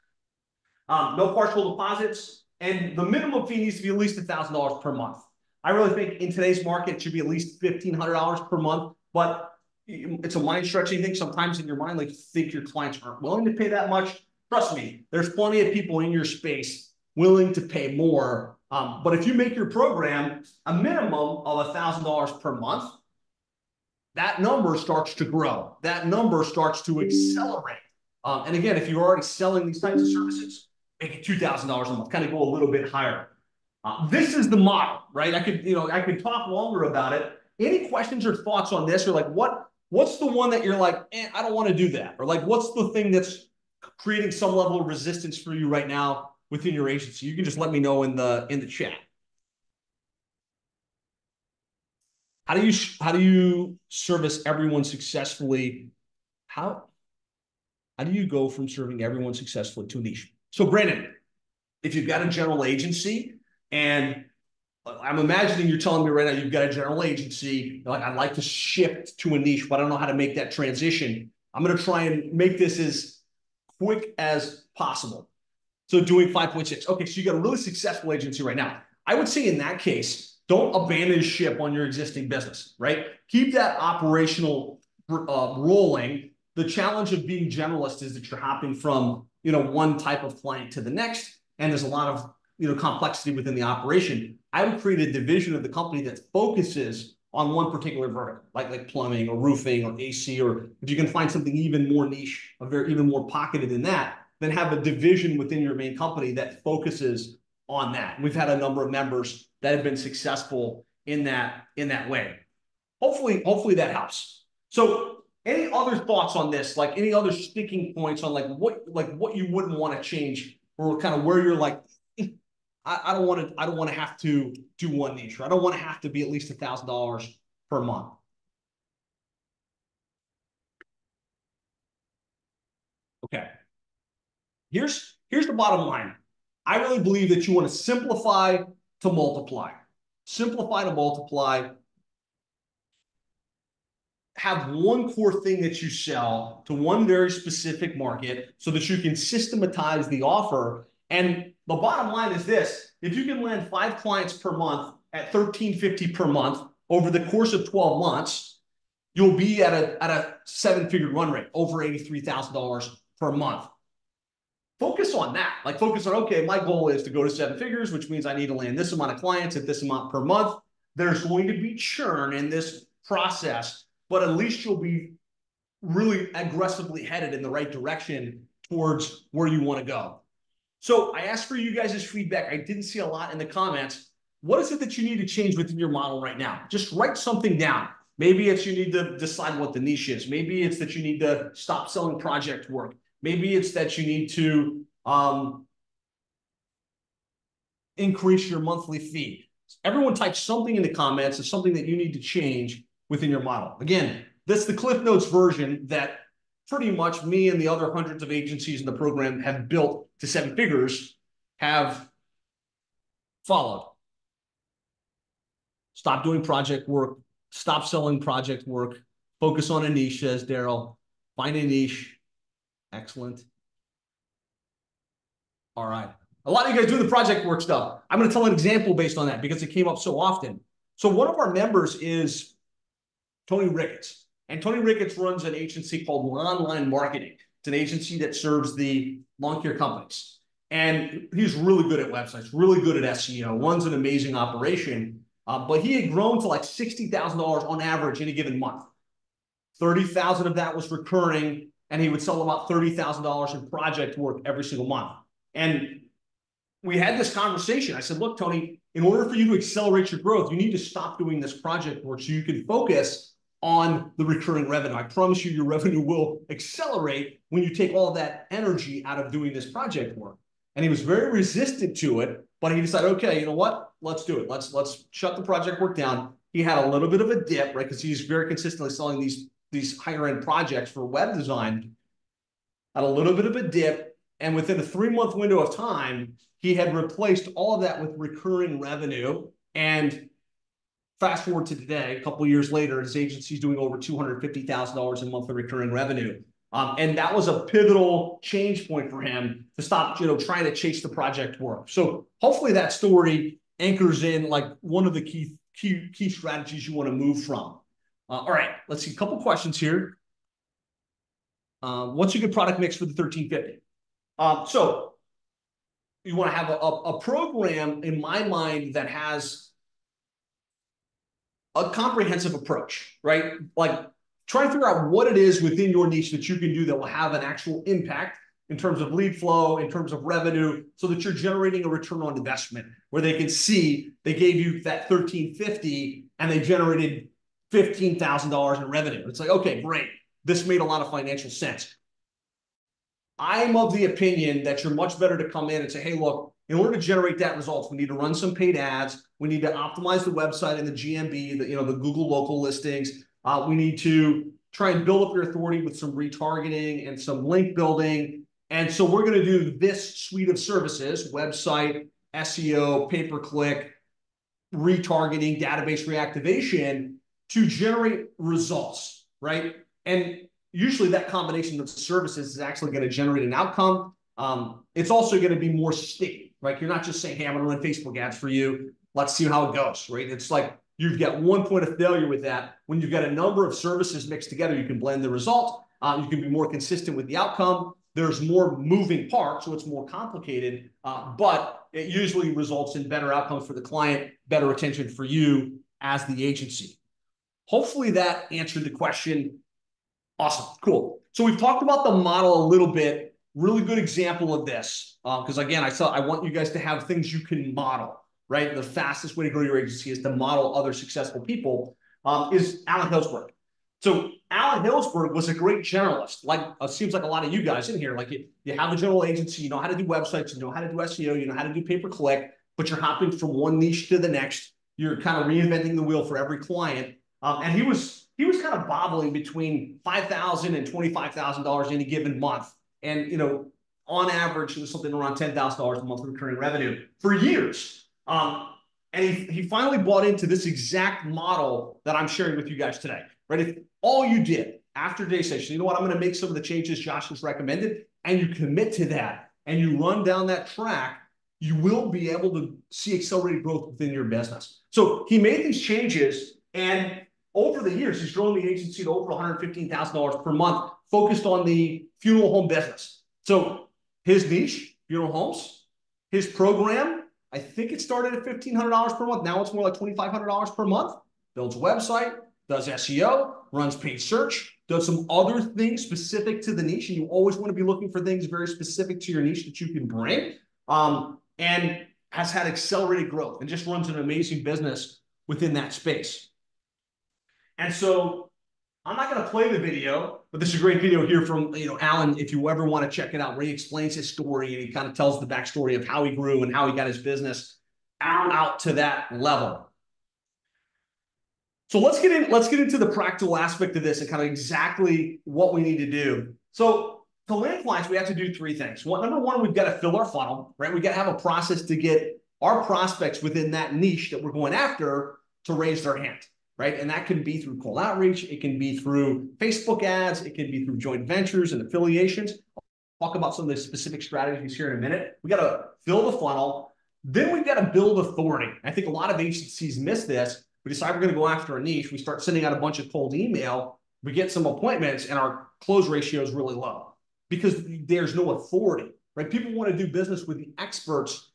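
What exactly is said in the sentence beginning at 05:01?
So hopefully that story anchors in like one of the key key key strategies you want to move from.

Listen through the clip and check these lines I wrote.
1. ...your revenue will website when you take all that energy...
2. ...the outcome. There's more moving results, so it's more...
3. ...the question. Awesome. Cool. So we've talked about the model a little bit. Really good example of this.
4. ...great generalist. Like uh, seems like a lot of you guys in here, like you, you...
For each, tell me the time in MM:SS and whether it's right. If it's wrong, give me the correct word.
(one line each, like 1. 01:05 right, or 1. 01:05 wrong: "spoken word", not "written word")
1. 04:25 wrong: "accelerate", not "website"
2. 06:27 wrong: "parts", not "results"
3. 06:38 right
4. 06:55 right.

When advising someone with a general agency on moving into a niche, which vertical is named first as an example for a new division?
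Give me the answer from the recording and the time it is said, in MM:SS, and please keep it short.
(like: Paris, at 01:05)
plumbing, at 01:38.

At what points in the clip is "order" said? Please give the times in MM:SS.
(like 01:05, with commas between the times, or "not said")
04:19, 05:46.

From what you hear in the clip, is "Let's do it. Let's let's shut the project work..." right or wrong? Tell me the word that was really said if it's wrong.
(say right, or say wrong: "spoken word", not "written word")
right.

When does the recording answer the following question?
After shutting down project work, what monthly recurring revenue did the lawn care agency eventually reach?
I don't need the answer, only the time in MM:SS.
04:53.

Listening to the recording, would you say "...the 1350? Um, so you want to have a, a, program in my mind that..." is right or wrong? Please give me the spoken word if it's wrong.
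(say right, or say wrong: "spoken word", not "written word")
right.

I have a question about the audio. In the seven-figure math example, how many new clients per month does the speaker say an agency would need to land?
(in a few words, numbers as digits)
5.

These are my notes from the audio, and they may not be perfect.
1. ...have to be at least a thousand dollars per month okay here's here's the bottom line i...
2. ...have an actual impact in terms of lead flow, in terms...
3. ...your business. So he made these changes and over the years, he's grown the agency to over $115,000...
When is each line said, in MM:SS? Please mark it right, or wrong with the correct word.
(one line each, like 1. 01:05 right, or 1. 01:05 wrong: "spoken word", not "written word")
1. 02:05 right
2. 05:27 right
3. 07:34 right.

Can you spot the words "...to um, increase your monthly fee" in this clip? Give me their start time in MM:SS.
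03:14.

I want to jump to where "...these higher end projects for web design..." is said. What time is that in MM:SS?
04:39.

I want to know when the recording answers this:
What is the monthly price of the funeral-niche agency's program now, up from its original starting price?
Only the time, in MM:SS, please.
07:49.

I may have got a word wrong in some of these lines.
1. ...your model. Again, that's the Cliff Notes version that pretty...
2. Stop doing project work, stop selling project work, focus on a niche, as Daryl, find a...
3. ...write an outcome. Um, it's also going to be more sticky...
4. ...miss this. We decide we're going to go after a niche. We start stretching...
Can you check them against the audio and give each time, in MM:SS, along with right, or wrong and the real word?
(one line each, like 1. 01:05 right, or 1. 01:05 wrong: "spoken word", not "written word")
1. 03:23 right
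2. 03:35 right
3. 06:13 wrong: "generate", not "write"
4. 08:49 wrong: "sending", not "stretching".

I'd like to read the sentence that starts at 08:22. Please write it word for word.
Let's get into the practical aspect of this and kind of exactly what we need to do.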